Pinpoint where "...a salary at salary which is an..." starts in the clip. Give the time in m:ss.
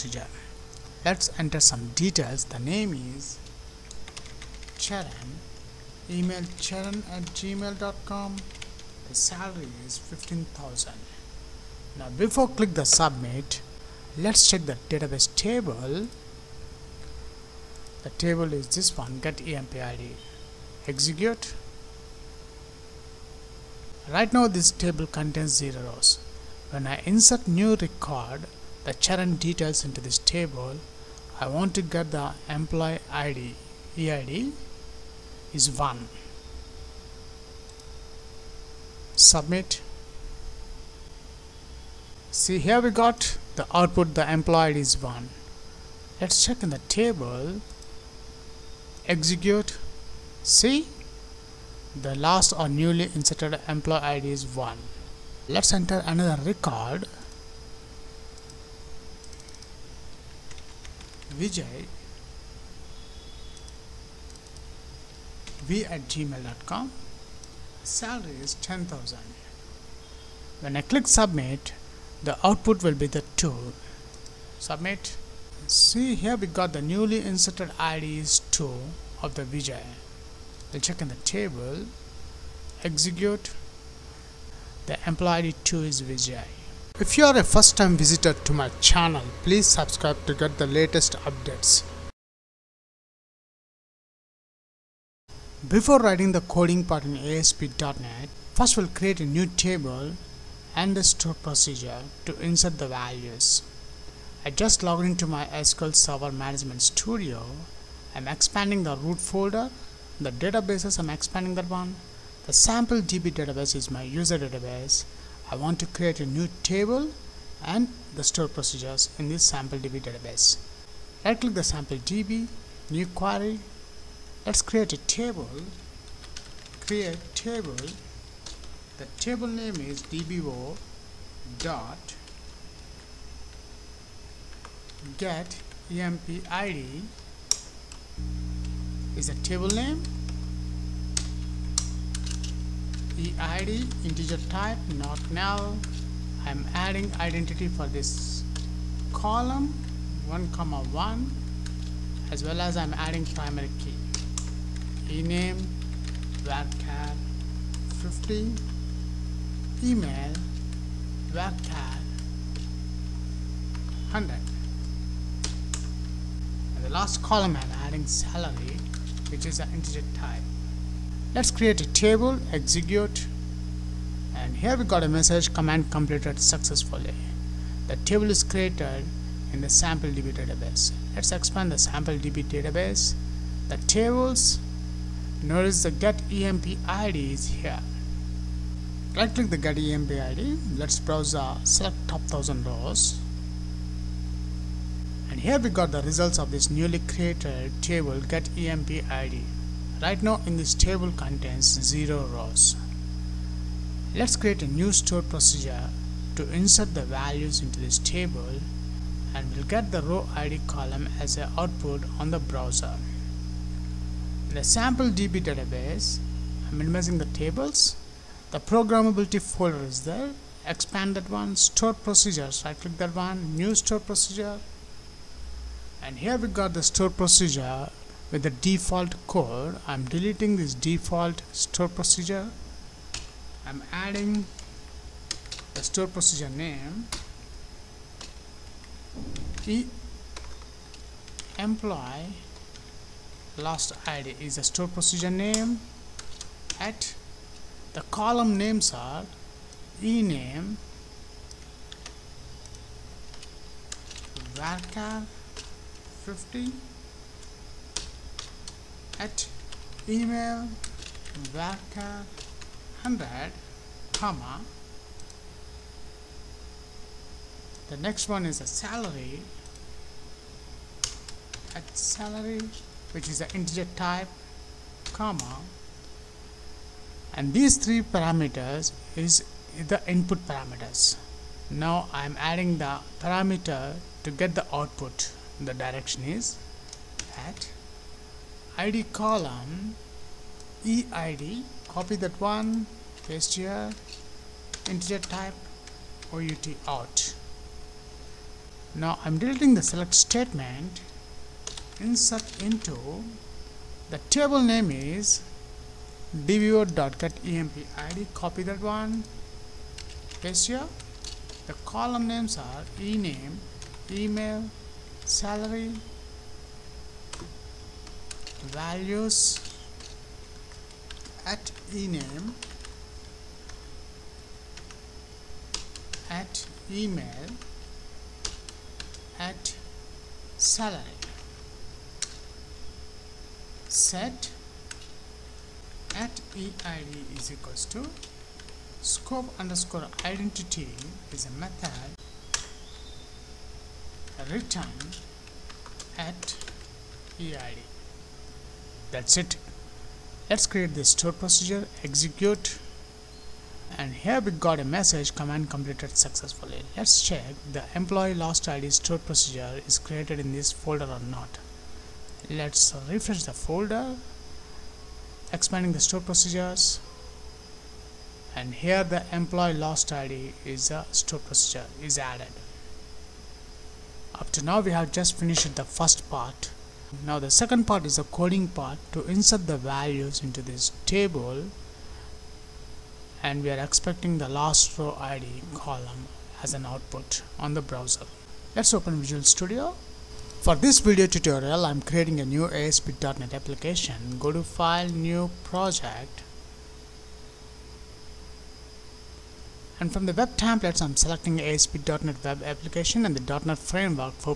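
4:28.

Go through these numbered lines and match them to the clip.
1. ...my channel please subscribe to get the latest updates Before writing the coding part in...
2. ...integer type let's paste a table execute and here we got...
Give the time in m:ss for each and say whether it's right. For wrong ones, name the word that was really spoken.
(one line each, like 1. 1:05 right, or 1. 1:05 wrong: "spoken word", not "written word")
1. 1:28 right
2. 2:49 wrong: "create", not "paste".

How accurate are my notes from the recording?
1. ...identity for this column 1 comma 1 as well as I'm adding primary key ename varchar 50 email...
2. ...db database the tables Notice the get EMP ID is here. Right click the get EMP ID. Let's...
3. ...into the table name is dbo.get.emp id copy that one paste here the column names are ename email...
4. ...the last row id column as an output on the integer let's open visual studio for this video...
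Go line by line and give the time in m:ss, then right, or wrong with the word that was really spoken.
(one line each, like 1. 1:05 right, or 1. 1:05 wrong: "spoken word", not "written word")
1. 2:27 right
2. 3:02 right
3. 5:02 right
4. 6:24 wrong: "browser", not "integer".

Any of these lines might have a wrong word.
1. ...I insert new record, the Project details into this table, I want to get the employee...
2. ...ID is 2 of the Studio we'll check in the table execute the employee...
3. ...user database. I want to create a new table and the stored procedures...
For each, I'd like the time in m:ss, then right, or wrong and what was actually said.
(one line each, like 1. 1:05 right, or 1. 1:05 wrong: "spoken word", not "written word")
1. 0:26 wrong: "Charan", not "Project"
2. 1:17 wrong: "Vijay", not "Studio"
3. 1:54 right.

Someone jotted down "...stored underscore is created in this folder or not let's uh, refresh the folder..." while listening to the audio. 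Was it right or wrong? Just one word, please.
wrong.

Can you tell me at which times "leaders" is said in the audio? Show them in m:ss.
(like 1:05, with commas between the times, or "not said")
not said.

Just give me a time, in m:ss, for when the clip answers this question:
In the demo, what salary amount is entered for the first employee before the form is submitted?
0:09.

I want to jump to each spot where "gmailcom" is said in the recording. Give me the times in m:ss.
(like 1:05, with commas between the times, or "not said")
0:07, 1:06.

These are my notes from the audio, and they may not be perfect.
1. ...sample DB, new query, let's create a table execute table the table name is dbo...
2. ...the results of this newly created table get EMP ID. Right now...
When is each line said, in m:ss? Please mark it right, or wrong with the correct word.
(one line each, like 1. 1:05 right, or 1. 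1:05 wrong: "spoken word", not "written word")
1. 2:01 wrong: "create", not "execute"
2. 3:15 right.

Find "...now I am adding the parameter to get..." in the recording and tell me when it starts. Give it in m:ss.
4:41.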